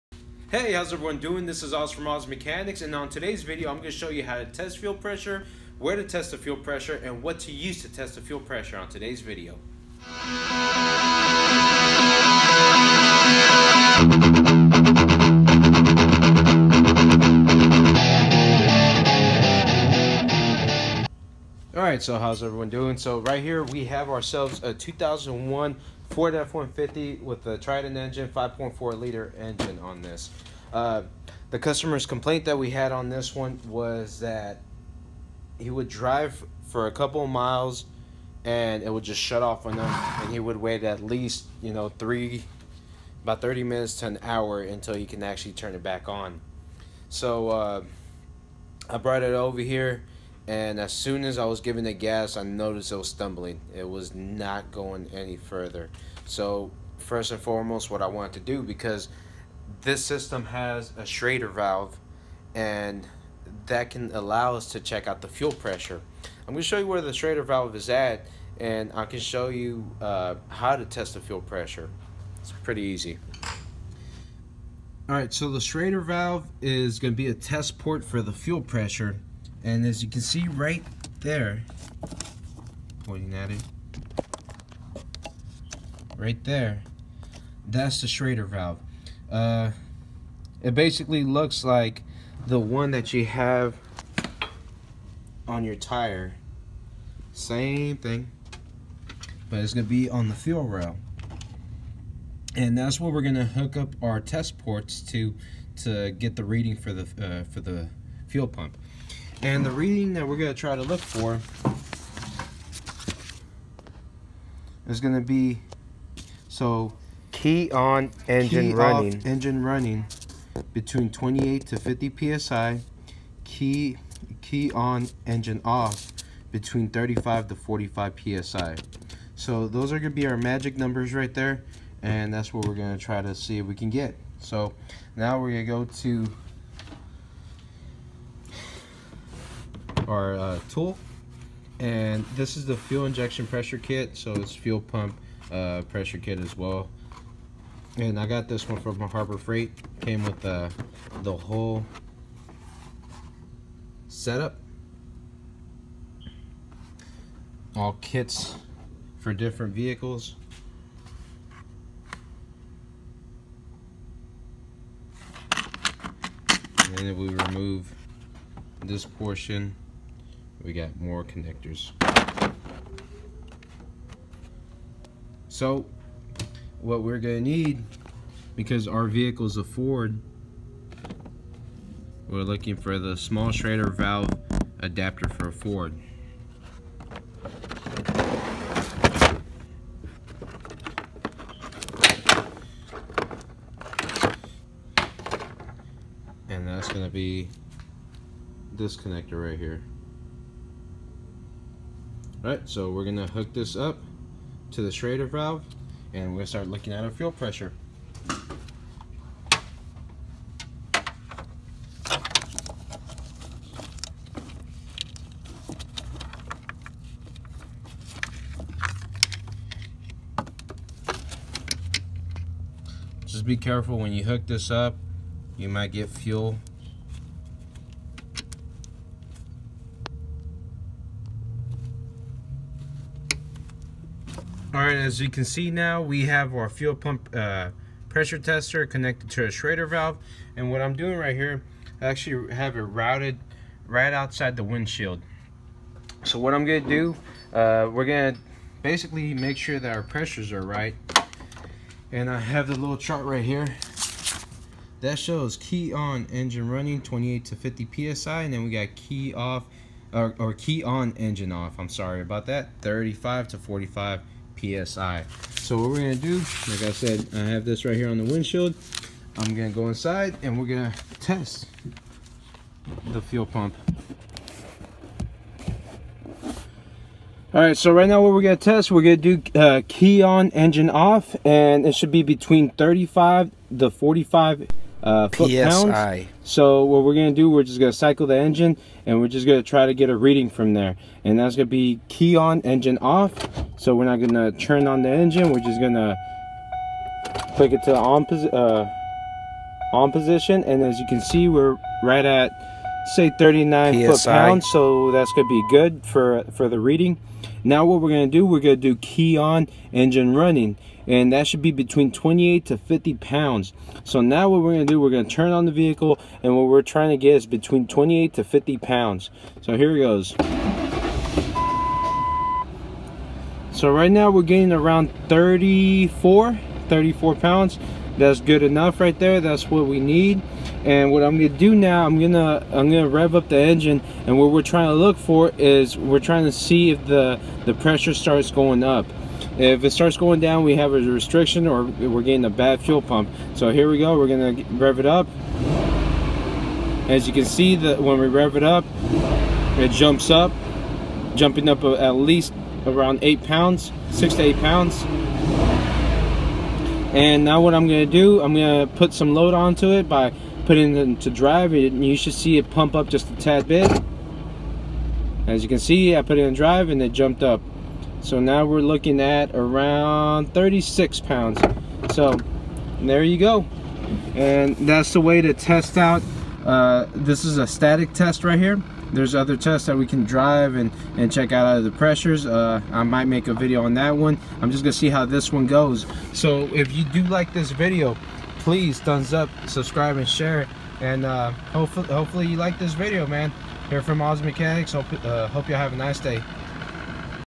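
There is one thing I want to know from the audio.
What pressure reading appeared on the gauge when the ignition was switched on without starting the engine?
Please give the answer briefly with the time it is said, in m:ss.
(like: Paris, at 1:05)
39 PSI, at 5:03.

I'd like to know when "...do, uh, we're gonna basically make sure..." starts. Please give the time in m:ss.
4:06.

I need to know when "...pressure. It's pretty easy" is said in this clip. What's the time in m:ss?
1:11.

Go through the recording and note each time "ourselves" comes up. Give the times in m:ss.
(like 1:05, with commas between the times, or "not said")
0:24.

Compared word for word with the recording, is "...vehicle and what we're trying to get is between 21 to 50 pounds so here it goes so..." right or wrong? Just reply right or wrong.
wrong.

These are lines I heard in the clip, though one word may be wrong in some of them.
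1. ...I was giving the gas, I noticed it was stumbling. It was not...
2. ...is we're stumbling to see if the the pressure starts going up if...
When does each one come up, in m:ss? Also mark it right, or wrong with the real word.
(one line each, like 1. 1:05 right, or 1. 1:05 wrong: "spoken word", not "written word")
1. 0:51 right
2. 5:35 wrong: "trying", not "stumbling".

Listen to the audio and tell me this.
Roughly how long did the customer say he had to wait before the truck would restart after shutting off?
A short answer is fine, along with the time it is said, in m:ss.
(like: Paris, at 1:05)
30 minutes to an hour, at 0:43.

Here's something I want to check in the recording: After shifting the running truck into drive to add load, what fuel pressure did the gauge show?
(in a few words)
36 pounds.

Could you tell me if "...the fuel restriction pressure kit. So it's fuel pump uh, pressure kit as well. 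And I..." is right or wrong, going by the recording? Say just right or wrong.
wrong.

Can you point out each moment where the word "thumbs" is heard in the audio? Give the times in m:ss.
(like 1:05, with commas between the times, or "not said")
6:28.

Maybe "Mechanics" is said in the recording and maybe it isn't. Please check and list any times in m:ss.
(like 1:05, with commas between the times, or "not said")
0:02, 6:34.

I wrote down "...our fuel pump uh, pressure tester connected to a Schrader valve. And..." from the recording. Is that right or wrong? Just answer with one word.
right.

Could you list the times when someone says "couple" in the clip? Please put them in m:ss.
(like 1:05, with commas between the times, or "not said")
0:36.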